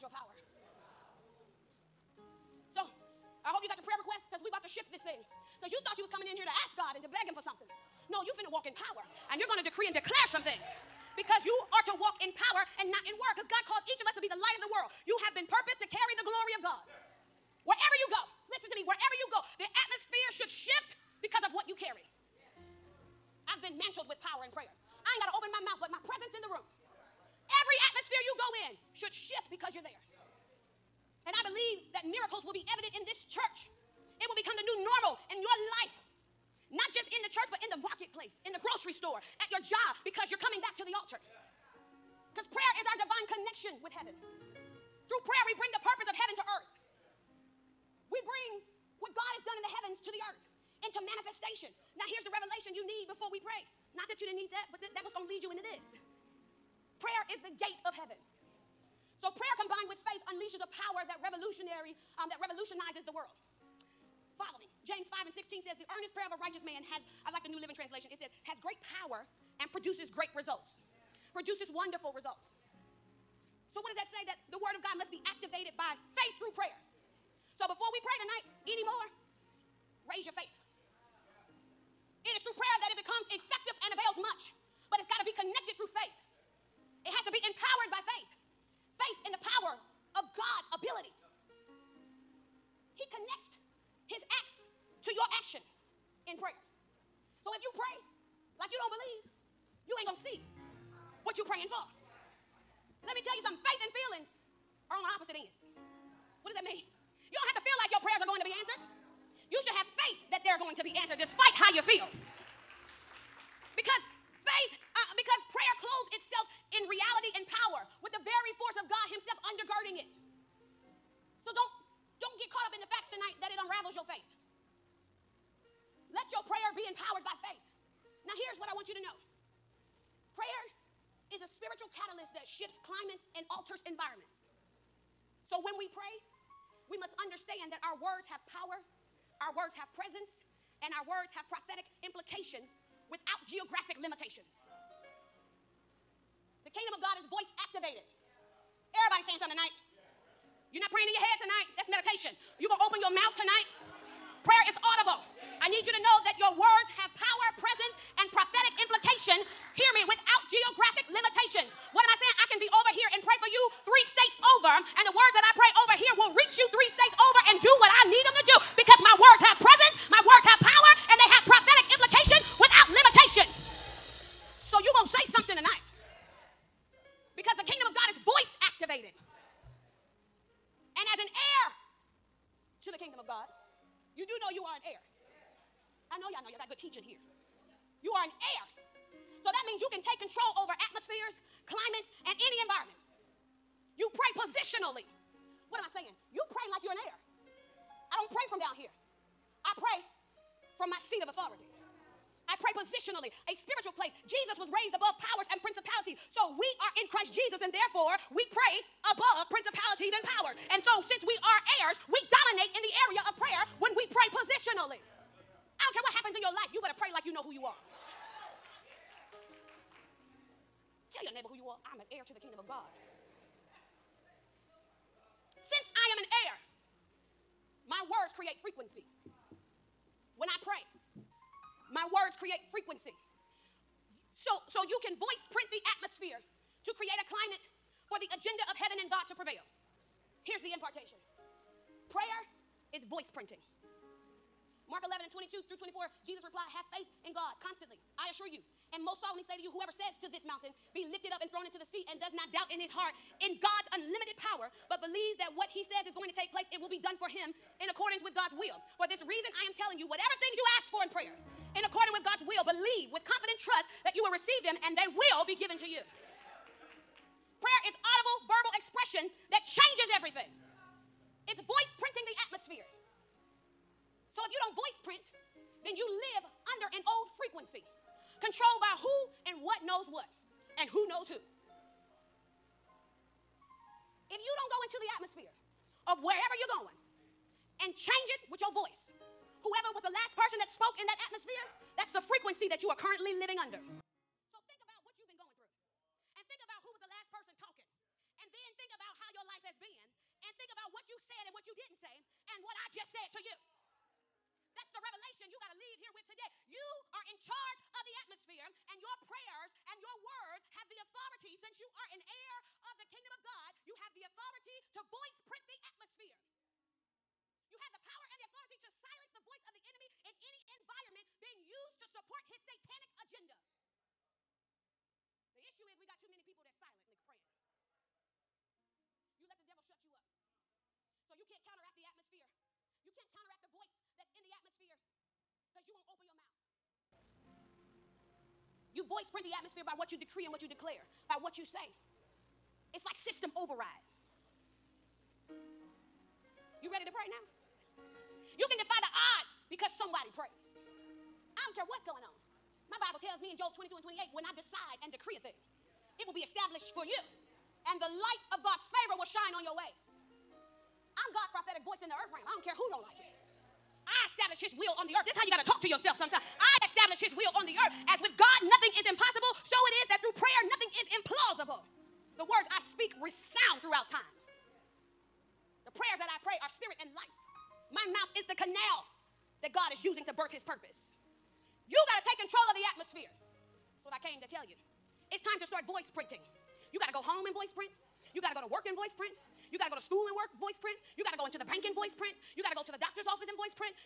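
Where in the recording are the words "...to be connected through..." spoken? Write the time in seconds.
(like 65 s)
85 s.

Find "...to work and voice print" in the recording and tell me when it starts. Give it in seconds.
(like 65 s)
388 s.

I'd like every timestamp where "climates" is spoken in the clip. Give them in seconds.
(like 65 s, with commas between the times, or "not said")
132 s, 191 s, 237 s.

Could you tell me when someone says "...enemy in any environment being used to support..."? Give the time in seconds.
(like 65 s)
319 s.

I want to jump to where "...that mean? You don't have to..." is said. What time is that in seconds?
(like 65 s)
106 s.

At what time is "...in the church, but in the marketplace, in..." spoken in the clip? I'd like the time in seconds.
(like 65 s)
37 s.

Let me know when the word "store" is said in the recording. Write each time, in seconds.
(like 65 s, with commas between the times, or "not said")
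38 s.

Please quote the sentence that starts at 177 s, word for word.
Because the kingdom of God is voice activated.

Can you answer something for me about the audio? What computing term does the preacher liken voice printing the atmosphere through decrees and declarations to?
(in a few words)
system override.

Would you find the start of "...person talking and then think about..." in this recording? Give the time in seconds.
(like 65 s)
297 s.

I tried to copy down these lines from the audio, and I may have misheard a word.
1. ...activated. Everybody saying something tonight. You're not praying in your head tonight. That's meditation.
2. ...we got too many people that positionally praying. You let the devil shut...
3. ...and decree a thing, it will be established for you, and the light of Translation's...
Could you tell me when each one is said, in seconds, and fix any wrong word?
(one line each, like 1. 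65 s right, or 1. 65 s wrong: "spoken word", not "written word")
1. 147 s right
2. 325 s wrong: "silently", not "positionally"
3. 355 s wrong: "God", not "Translation".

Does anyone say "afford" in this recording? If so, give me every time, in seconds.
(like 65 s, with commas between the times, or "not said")
not said.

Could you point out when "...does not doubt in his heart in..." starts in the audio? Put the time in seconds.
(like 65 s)
252 s.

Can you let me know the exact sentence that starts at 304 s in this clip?
That's the revelation you got to leave here with today.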